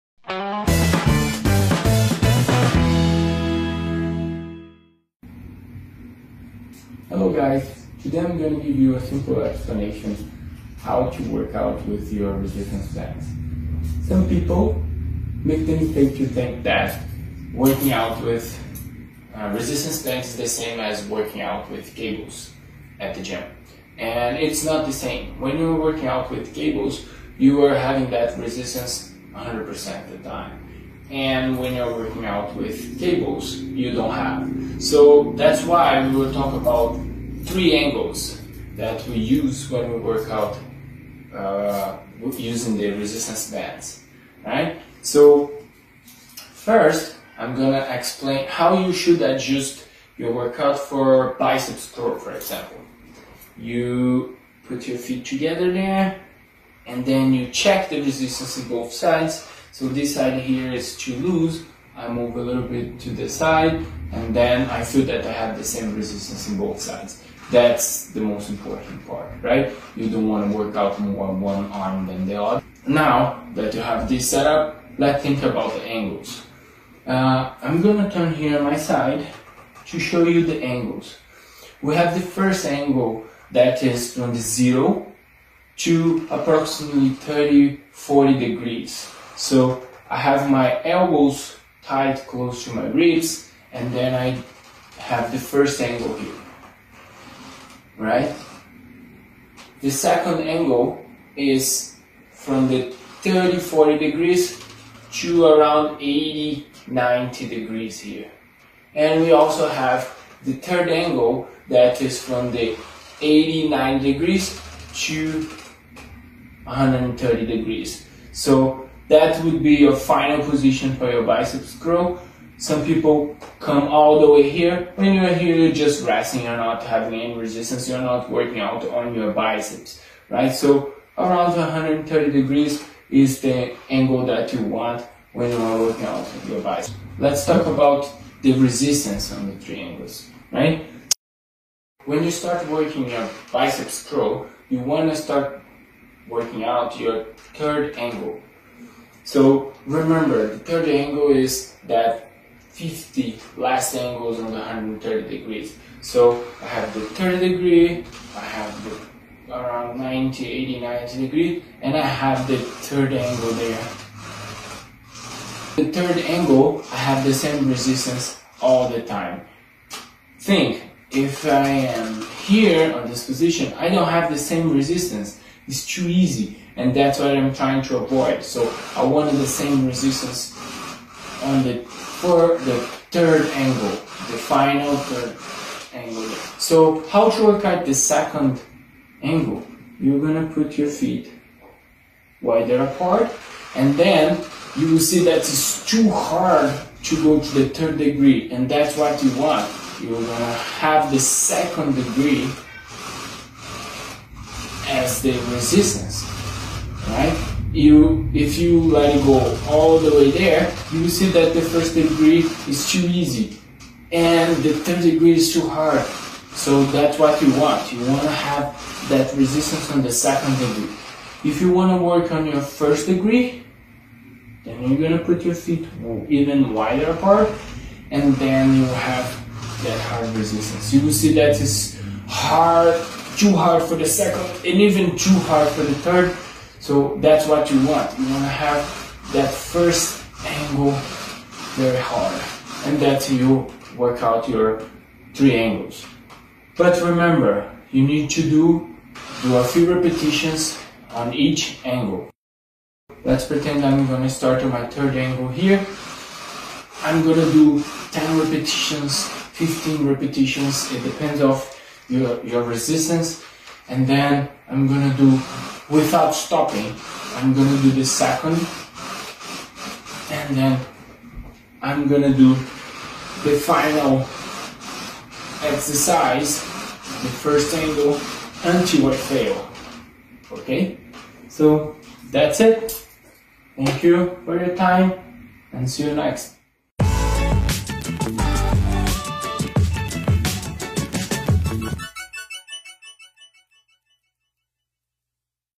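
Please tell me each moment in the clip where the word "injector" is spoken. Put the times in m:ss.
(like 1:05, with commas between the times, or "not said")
not said.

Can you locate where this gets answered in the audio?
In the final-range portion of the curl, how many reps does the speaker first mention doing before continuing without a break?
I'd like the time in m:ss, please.
4:18.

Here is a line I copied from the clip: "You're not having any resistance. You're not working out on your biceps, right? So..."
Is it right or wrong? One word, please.
right.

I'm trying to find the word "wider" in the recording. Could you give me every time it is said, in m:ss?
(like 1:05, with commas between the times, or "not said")
3:12, 3:46.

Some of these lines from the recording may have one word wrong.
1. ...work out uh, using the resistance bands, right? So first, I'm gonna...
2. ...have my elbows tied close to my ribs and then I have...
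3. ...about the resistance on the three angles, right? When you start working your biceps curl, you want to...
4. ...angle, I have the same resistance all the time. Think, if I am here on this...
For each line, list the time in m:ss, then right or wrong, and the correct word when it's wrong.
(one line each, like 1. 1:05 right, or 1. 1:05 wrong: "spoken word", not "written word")
1. 0:39 right
2. 1:30 right
3. 2:17 right
4. 2:46 right.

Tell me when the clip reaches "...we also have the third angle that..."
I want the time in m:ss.
1:49.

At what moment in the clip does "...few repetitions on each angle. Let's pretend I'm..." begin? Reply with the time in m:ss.
4:09.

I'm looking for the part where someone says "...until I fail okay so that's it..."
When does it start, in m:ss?
4:38.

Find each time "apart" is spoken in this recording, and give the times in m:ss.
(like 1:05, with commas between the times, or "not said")
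3:12, 3:47.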